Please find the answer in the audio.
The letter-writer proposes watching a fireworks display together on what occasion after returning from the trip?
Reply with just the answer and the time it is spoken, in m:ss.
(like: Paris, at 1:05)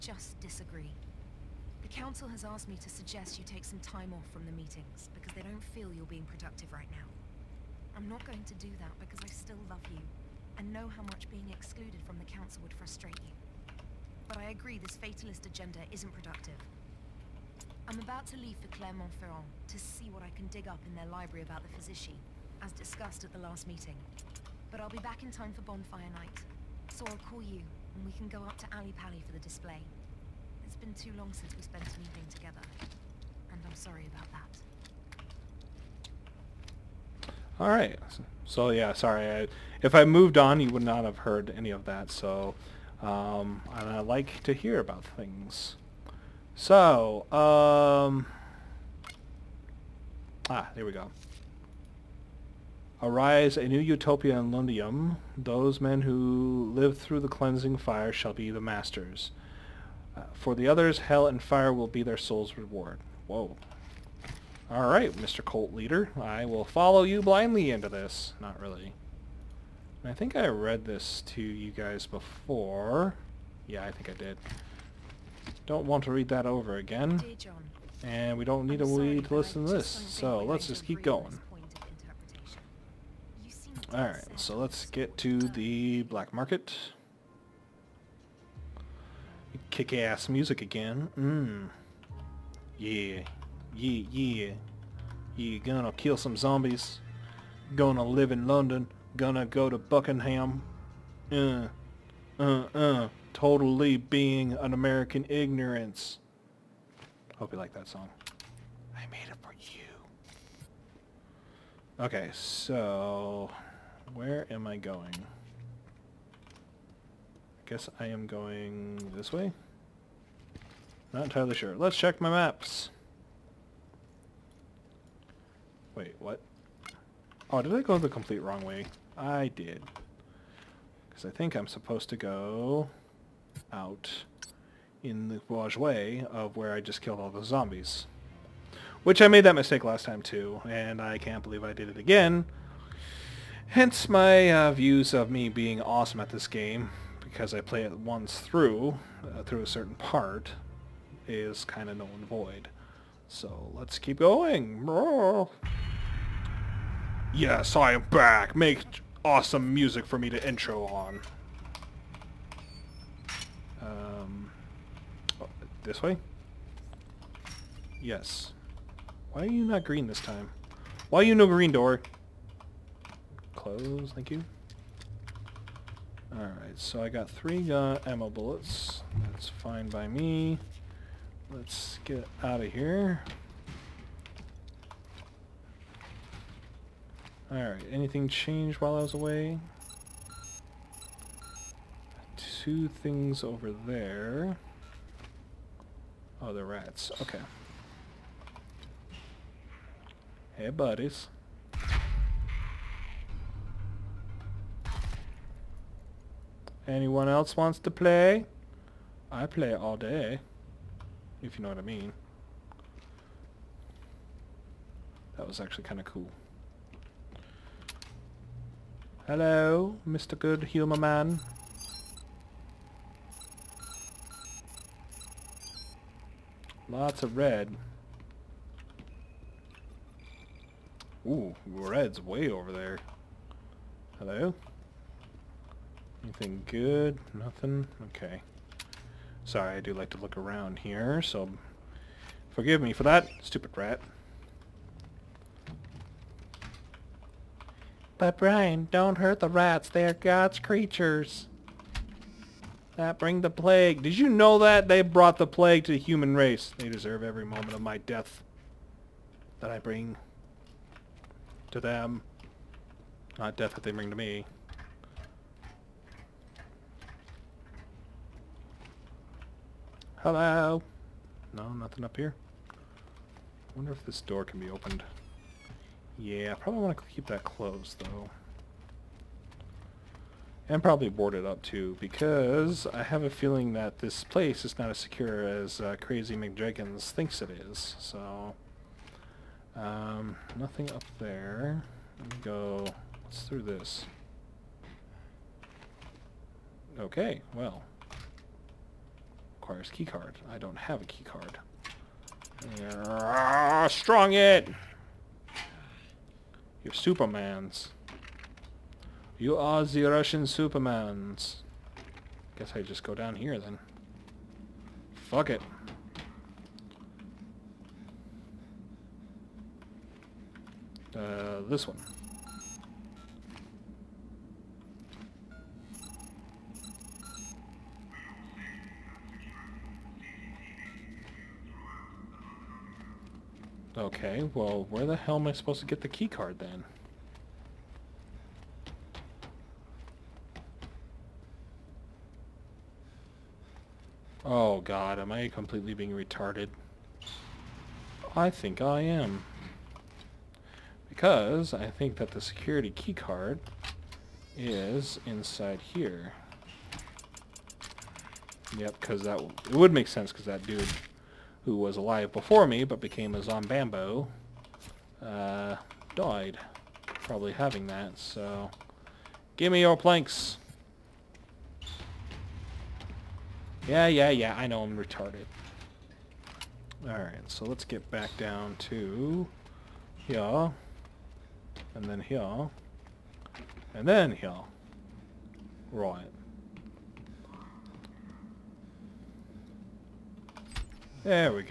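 Bonfire Night, at 0:25.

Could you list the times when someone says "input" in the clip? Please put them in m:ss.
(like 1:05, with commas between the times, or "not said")
not said.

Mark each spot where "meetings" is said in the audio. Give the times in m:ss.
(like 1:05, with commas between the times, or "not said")
0:04, 0:23.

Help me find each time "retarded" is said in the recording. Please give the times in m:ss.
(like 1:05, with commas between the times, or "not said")
5:46, 6:14.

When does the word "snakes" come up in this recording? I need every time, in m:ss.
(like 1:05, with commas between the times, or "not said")
not said.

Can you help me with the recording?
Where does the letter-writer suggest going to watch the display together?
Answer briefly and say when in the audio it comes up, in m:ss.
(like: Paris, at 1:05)
Ally Pally, at 0:28.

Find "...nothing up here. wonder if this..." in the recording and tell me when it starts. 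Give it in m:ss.
4:31.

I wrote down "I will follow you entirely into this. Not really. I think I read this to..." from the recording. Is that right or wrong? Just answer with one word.
wrong.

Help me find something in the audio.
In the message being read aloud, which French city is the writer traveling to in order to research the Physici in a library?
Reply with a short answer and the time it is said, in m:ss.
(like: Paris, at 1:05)
Clermont-Ferrand, at 0:18.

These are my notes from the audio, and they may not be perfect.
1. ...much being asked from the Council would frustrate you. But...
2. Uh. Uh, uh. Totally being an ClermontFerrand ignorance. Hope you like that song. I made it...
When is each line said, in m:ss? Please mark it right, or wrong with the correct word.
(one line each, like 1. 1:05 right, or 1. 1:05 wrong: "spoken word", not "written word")
1. 0:11 wrong: "excluded", not "asked"
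2. 1:41 wrong: "American", not "ClermontFerrand".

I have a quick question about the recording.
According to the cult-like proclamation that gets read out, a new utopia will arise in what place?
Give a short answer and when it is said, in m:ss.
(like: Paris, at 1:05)
Lundium, at 0:54.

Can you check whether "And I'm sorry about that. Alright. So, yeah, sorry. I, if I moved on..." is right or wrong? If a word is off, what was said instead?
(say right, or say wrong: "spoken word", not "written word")
right.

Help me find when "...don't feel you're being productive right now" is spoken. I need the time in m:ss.
0:05.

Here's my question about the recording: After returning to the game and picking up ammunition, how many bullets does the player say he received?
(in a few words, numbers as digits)
3.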